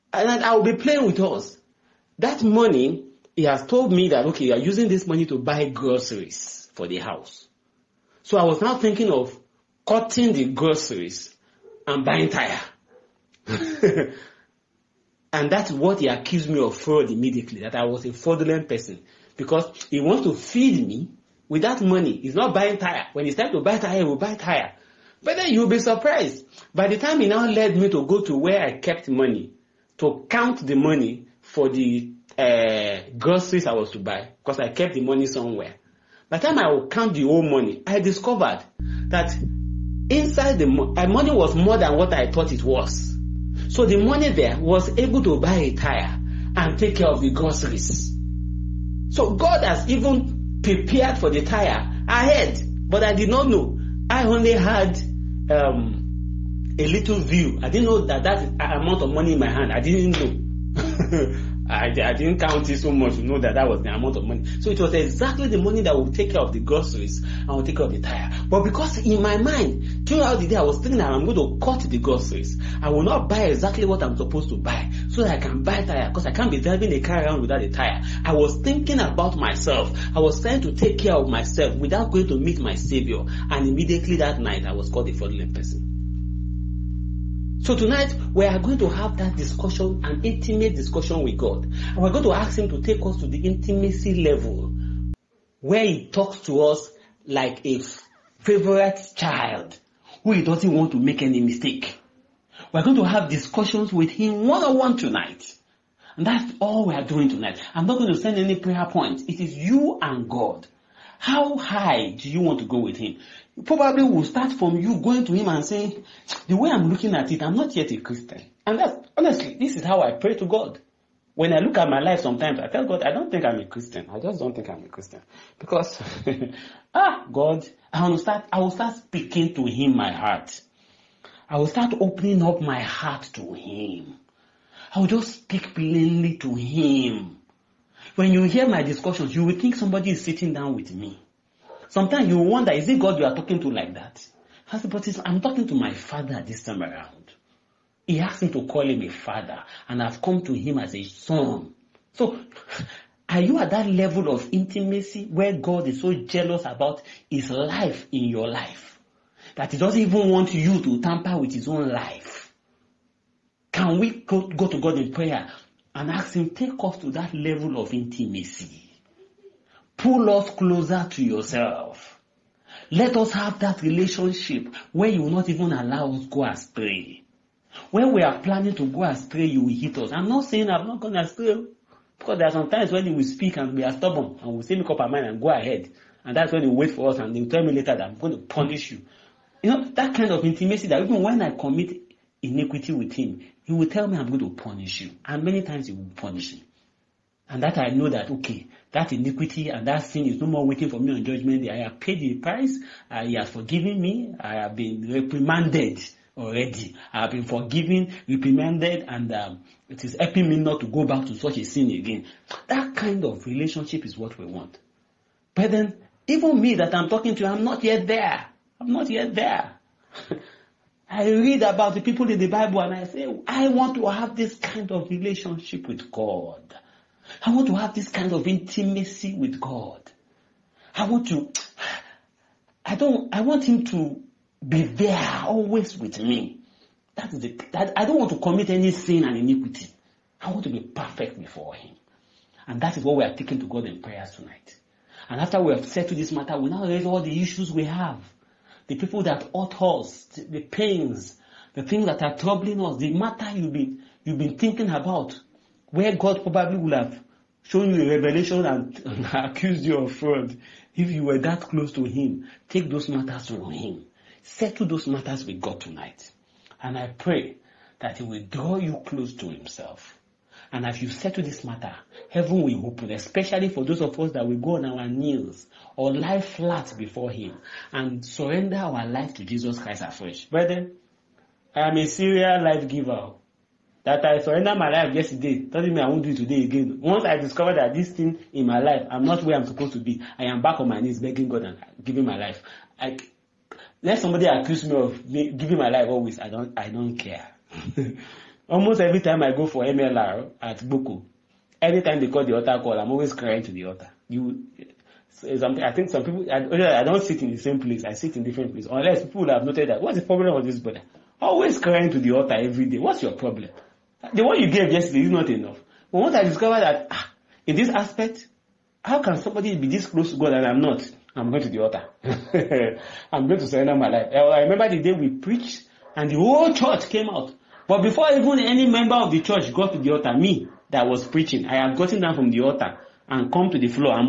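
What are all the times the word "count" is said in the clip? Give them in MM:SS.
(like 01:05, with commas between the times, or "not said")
00:30, 00:36, 01:02.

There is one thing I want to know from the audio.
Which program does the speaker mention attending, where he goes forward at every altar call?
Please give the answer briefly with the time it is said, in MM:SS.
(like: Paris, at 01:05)
MLR, at 04:59.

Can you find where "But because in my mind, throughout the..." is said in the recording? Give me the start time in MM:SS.
01:08.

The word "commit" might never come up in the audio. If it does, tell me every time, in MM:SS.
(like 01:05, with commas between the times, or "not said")
03:11, 03:58.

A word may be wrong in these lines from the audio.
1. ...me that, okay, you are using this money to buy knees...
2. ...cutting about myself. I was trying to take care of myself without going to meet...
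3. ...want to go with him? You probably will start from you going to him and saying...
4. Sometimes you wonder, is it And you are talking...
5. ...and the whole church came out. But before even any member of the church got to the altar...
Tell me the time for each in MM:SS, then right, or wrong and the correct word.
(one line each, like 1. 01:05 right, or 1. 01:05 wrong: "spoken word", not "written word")
1. 00:03 wrong: "groceries", not "knees"
2. 01:18 wrong: "thinking", not "cutting"
3. 01:52 right
4. 02:21 wrong: "God", not "And"
5. 05:26 right.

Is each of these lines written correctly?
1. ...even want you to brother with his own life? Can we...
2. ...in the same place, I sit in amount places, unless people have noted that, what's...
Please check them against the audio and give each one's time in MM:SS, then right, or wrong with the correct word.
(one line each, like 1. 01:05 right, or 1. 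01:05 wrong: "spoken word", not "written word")
1. 02:40 wrong: "tamper", not "brother"
2. 05:07 wrong: "different", not "amount".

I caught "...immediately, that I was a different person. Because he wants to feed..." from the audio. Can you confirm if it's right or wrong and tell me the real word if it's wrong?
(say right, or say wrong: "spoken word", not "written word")
wrong: "fraudulent", not "different".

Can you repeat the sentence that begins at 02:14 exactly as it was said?
I will just speak plainly to him.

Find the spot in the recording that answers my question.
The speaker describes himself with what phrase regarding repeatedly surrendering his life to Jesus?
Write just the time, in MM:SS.
04:42.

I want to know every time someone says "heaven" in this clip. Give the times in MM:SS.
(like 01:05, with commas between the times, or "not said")
04:32.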